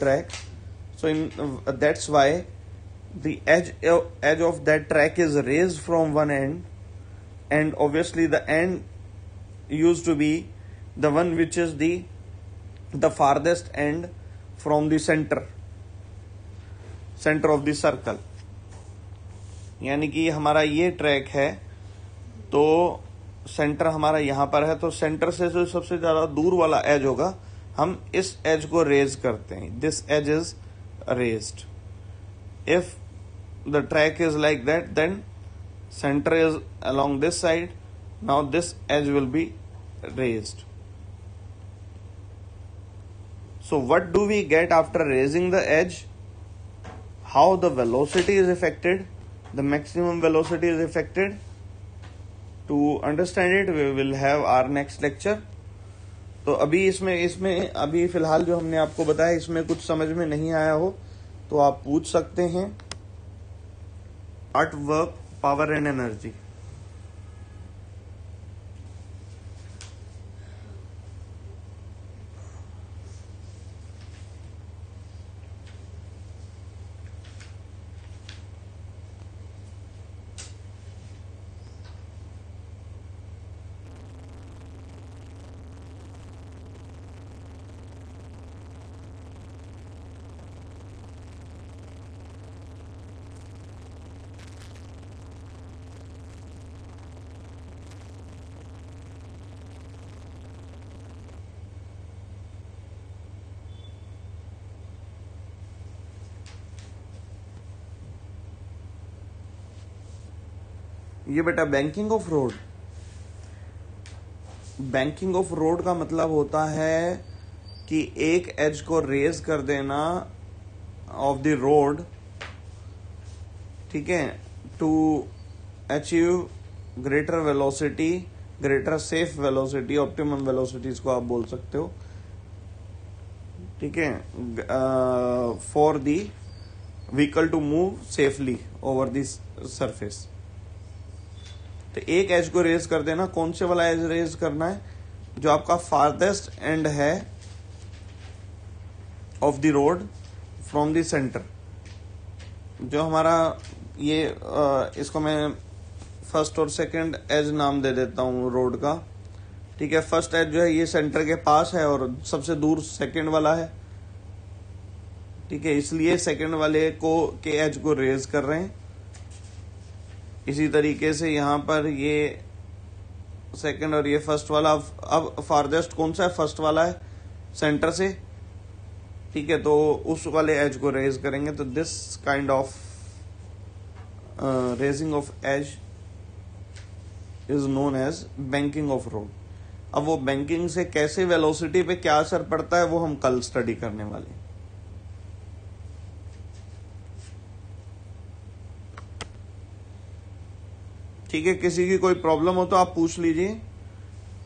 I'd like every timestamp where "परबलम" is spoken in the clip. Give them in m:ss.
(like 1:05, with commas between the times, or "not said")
3:22.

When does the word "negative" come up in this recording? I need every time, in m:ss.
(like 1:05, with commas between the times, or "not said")
not said.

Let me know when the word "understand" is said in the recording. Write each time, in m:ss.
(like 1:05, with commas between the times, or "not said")
0:53.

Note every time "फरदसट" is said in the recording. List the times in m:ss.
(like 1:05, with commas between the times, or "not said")
0:13, 2:25, 2:55.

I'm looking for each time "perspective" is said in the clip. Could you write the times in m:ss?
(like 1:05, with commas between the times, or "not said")
not said.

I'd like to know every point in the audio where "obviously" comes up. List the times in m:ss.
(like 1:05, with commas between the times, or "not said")
0:07.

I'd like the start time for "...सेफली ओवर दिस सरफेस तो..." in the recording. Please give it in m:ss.
2:18.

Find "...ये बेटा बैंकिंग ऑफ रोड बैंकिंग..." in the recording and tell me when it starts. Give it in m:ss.
1:51.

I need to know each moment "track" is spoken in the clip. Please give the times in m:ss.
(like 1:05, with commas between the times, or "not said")
0:00, 0:04.